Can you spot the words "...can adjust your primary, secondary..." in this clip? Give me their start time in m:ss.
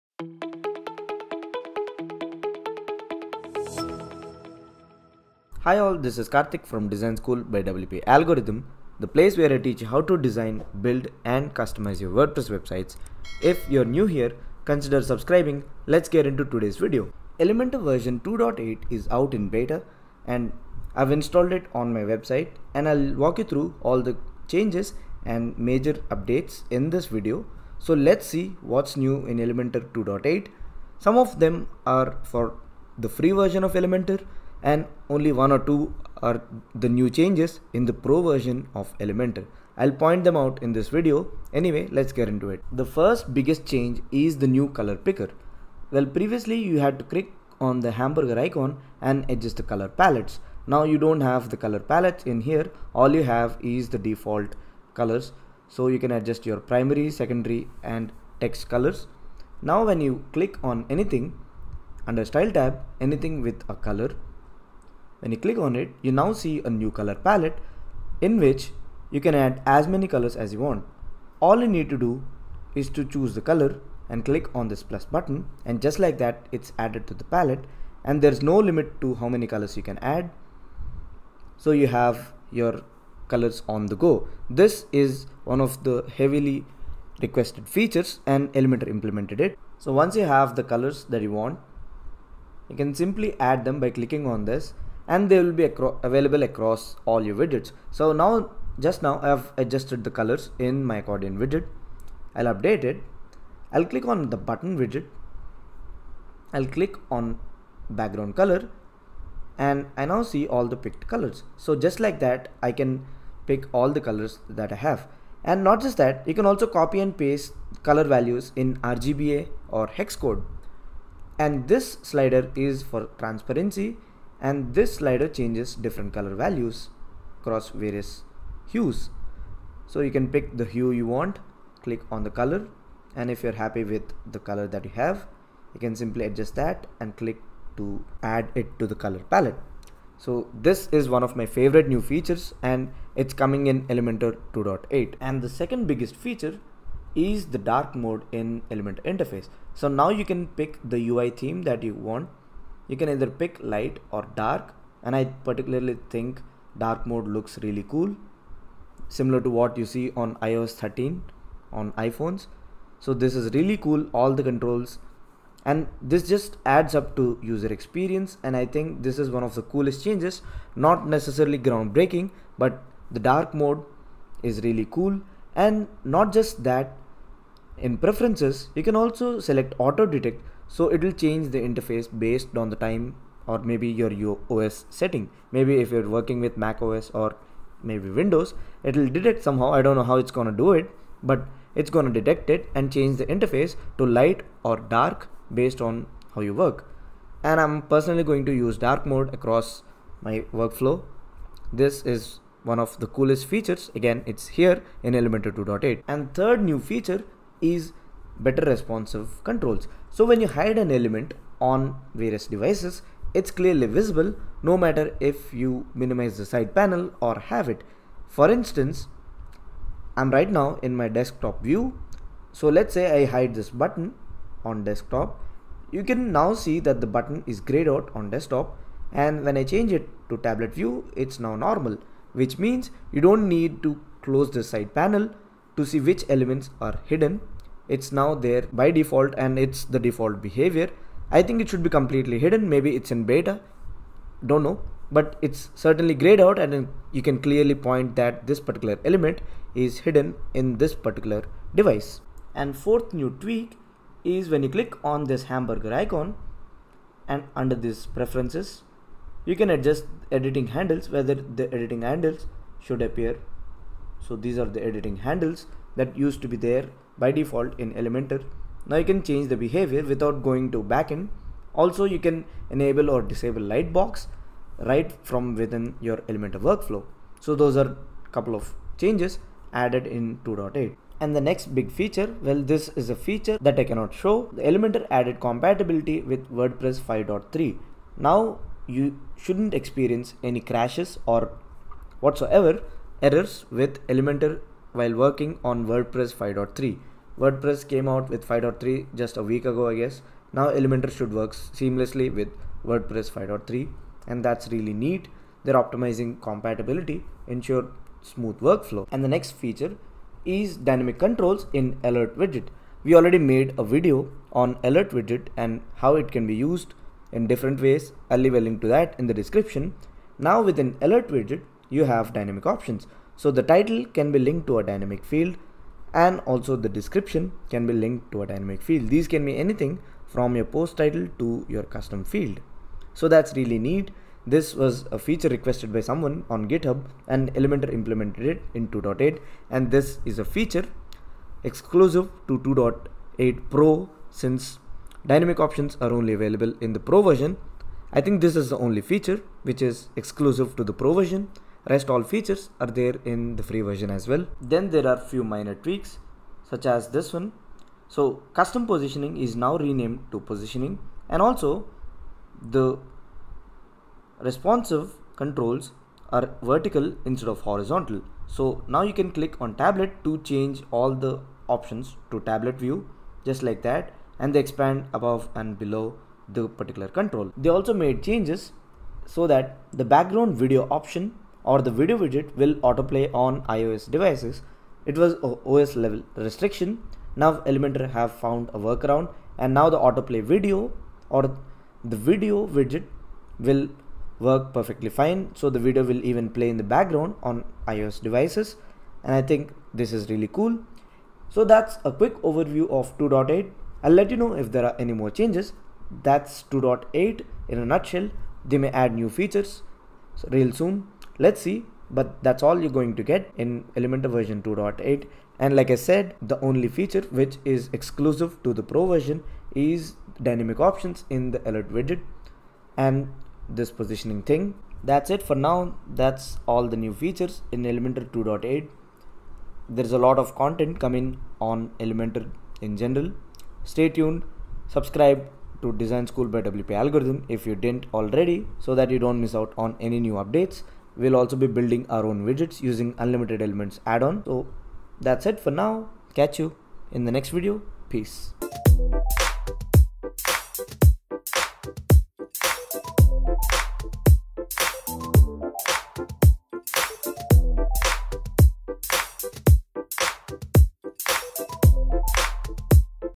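0:55.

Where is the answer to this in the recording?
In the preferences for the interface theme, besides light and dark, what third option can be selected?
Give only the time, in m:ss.
2:59.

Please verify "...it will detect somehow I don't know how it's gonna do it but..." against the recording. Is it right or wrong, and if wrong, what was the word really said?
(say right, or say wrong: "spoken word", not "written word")
right.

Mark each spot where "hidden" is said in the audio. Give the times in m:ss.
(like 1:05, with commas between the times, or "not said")
3:57, 4:02, 4:09.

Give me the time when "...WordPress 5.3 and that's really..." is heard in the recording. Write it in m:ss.
5:02.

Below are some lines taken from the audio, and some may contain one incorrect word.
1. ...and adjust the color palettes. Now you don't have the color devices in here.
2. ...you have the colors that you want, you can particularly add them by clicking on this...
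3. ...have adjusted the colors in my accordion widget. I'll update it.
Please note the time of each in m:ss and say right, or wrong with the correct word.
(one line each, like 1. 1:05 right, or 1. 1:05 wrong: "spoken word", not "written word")
1. 0:49 wrong: "palettes", not "devices"
2. 1:30 wrong: "simply", not "particularly"
3. 1:39 right.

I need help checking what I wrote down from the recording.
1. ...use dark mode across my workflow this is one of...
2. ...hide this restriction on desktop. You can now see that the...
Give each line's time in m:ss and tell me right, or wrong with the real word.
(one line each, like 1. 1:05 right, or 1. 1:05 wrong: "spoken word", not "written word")
1. 3:18 right
2. 3:43 wrong: "button", not "restriction".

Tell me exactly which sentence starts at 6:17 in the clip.
They also made changes so that the background video option or the video widget will autoplay on iOS devices.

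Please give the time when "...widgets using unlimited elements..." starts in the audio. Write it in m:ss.
7:22.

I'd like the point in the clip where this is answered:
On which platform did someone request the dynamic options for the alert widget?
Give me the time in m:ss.
5:36.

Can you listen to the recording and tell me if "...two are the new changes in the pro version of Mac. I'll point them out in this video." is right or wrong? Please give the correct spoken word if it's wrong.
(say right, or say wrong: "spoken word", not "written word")
wrong: "Elementor", not "Mac".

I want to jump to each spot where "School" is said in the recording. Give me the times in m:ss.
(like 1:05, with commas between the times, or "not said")
0:07, 7:16.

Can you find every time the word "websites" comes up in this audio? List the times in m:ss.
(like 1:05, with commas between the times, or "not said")
0:12, 0:21.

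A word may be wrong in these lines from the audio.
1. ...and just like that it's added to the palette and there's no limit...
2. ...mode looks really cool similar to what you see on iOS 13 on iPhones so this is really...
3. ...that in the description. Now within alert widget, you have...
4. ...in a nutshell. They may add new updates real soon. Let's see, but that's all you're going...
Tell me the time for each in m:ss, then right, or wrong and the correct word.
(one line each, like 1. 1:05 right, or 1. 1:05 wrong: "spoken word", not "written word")
1. 1:15 right
2. 2:37 right
3. 5:18 right
4. 6:47 wrong: "features", not "updates".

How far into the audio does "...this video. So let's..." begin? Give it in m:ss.
0:26.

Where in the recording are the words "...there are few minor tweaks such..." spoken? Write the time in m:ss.
5:54.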